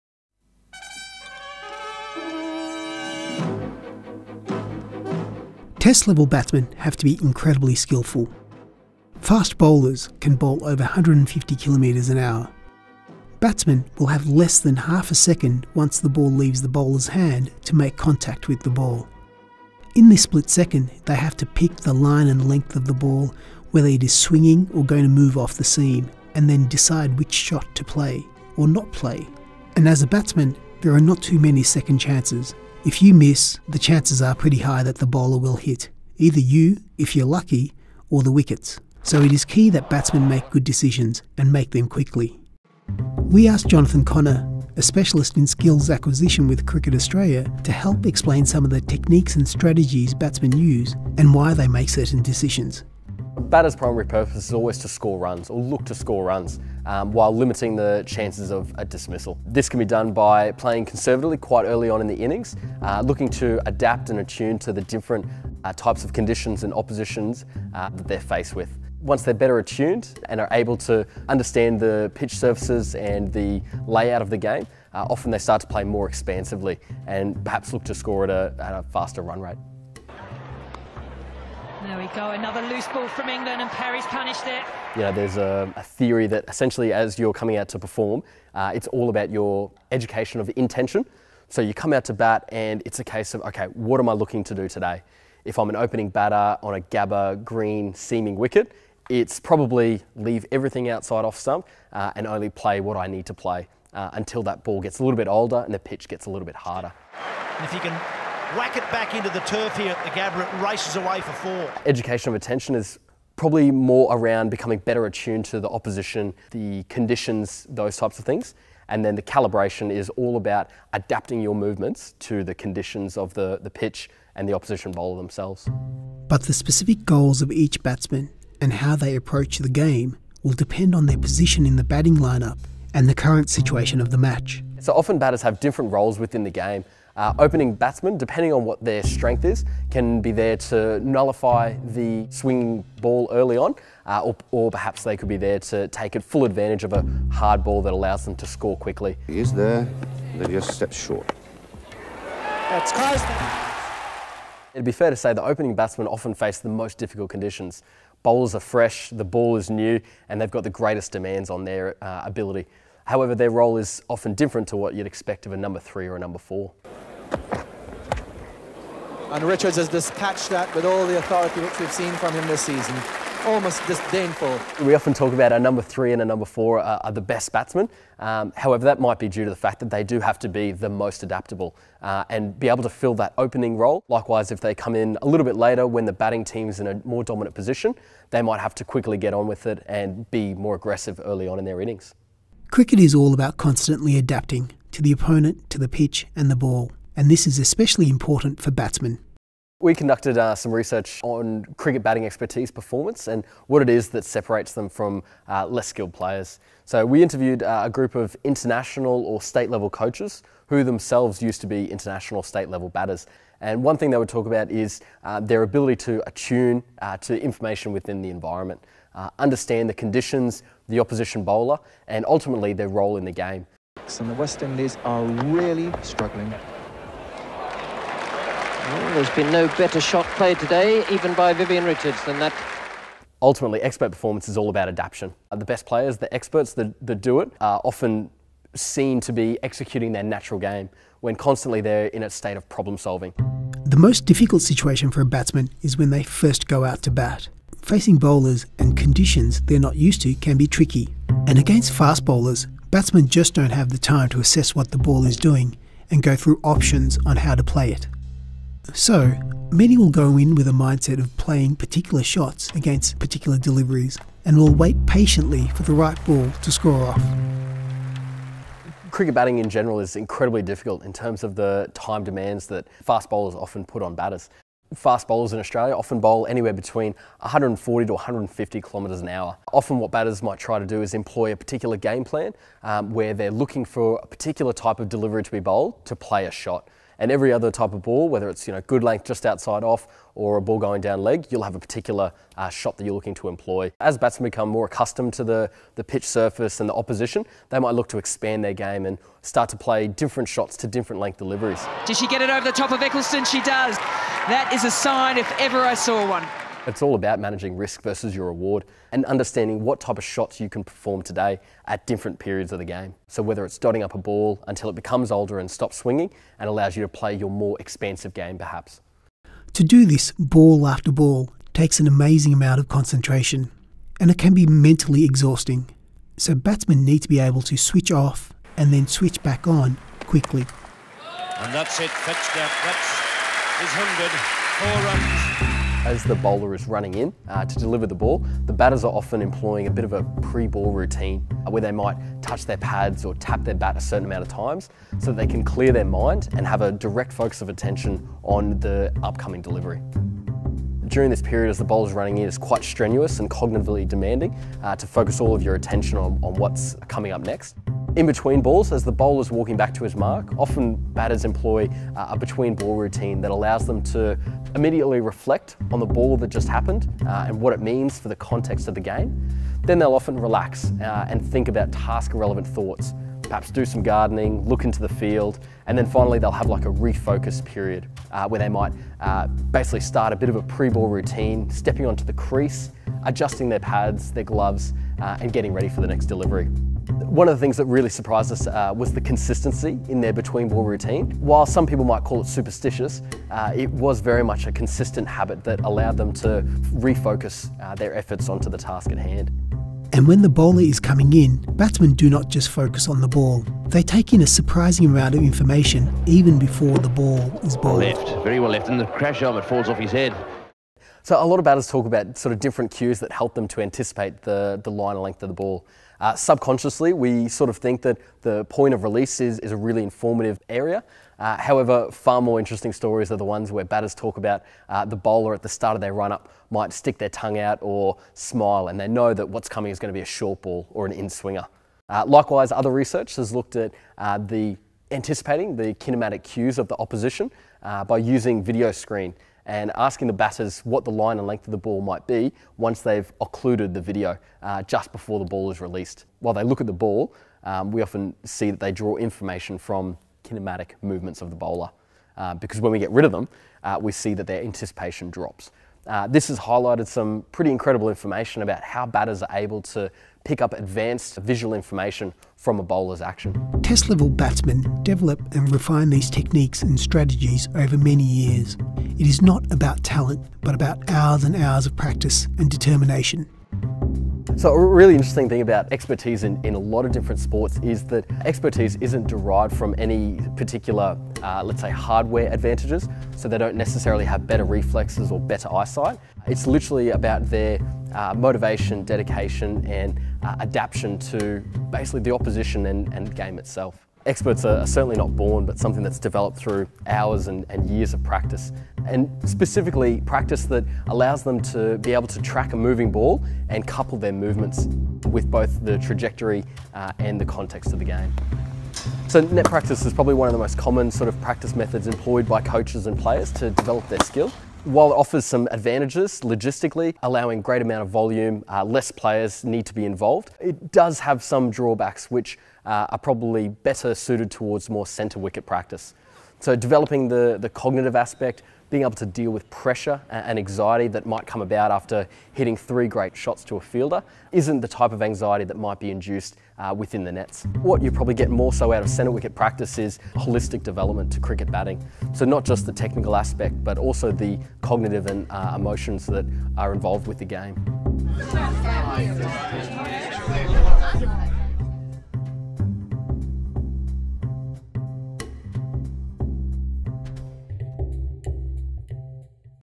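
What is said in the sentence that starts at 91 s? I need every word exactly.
So you come out to bat, and it's a case of, okay, what am I looking to do today?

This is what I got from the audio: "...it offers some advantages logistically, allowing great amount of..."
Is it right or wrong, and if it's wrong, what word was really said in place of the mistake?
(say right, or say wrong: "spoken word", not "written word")
right.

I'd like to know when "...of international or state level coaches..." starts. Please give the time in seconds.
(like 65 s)
208 s.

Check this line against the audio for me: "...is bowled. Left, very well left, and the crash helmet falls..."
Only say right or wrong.
right.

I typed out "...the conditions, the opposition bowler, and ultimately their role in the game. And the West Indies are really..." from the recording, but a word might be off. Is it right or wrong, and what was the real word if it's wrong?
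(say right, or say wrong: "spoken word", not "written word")
right.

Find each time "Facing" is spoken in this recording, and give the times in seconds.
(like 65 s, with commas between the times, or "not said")
247 s.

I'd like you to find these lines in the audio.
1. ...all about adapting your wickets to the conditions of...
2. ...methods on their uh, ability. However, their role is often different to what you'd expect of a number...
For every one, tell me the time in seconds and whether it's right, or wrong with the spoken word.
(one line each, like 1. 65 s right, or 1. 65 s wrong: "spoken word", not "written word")
1. 120 s wrong: "movements", not "wickets"
2. 161 s wrong: "demands", not "methods".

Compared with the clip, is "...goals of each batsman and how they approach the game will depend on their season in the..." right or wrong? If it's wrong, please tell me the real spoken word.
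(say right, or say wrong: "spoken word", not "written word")
wrong: "position", not "season".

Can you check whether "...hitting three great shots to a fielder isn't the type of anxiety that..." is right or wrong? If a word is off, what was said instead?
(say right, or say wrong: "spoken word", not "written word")
right.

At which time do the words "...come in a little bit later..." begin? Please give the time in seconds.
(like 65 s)
184 s.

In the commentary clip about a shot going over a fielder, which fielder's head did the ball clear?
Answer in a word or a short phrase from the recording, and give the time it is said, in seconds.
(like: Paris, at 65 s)
Ecclestone, at 303 s.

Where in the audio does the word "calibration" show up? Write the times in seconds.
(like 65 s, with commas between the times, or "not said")
119 s.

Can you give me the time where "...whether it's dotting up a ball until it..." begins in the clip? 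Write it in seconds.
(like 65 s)
313 s.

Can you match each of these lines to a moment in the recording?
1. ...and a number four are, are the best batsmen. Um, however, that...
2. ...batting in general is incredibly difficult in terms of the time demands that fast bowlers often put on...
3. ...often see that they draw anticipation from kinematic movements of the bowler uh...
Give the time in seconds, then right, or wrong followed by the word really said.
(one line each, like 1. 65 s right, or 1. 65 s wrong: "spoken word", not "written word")
1. 176 s right
2. 269 s right
3. 448 s wrong: "information", not "anticipation".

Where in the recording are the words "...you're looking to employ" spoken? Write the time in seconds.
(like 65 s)
293 s.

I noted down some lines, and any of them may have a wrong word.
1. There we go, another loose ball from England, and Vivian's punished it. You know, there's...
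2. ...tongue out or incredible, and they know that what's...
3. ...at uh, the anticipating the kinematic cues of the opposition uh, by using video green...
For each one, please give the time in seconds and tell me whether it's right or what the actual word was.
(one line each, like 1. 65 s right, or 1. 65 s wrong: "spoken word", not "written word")
1. 81 s wrong: "Perry", not "Vivian"
2. 427 s wrong: "smile", not "incredible"
3. 433 s wrong: "screen", not "green".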